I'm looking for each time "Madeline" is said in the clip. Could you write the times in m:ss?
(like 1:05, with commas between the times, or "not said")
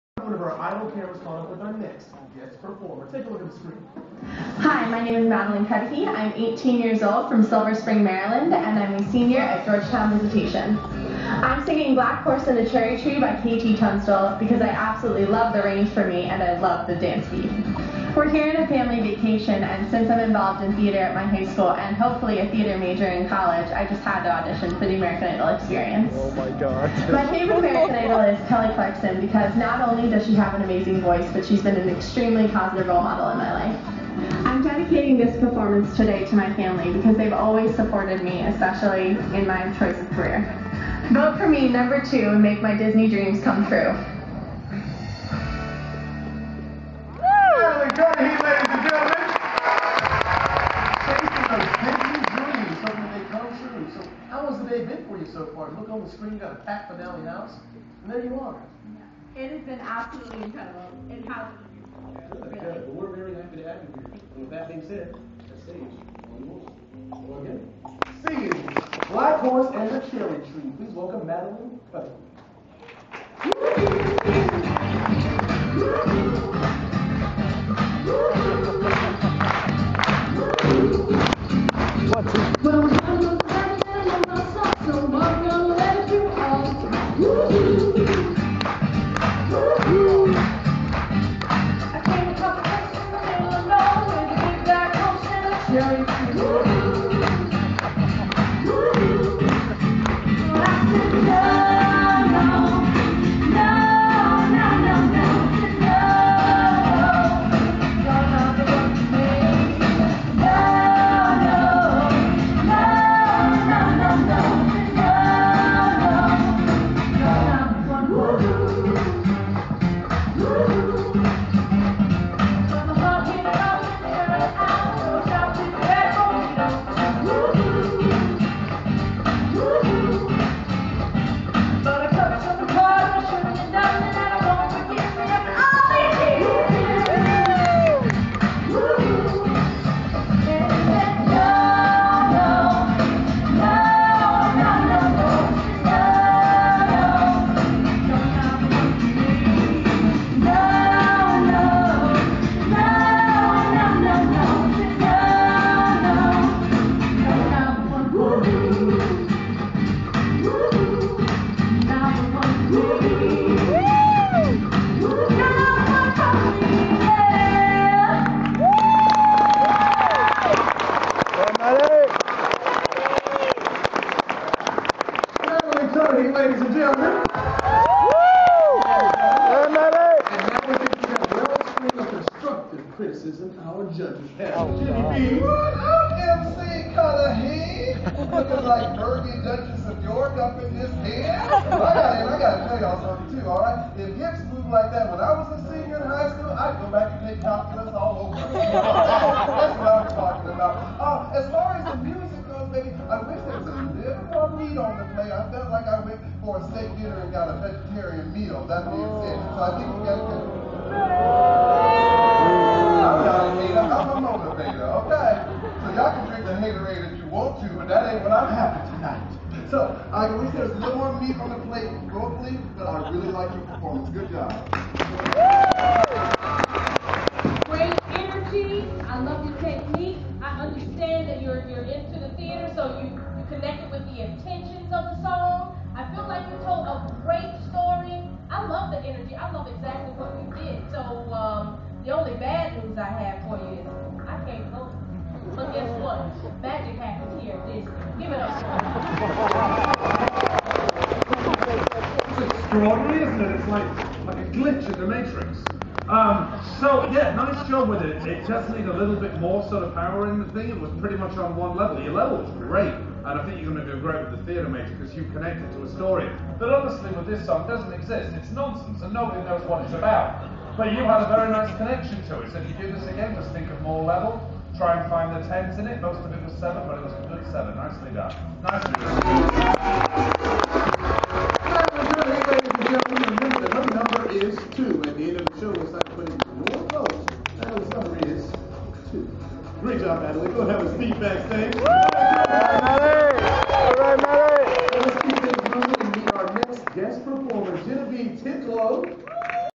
0:05, 1:11.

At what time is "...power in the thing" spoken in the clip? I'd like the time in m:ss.
4:19.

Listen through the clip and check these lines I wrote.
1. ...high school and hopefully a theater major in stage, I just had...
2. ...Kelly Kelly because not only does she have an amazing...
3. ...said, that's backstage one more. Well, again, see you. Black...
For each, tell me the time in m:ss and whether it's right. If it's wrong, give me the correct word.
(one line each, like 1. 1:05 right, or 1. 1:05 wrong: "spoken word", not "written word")
1. 0:21 wrong: "college", not "stage"
2. 0:28 wrong: "Clarkson", not "Kelly"
3. 1:04 wrong: "stage", not "backstage".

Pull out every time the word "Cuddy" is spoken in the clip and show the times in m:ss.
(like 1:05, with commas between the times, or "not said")
0:05, 1:11.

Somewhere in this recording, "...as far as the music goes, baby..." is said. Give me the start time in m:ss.
3:21.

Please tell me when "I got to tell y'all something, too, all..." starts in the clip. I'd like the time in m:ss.
3:11.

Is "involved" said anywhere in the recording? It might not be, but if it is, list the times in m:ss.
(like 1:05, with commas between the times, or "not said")
0:20.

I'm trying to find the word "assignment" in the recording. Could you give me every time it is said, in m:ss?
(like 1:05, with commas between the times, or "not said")
not said.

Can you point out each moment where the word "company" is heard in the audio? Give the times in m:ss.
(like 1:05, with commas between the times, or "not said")
not said.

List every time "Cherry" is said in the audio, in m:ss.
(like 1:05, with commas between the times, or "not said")
0:12, 1:10.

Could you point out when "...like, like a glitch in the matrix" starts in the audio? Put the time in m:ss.
4:13.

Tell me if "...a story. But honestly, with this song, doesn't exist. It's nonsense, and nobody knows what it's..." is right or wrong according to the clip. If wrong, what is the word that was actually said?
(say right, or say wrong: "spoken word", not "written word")
right.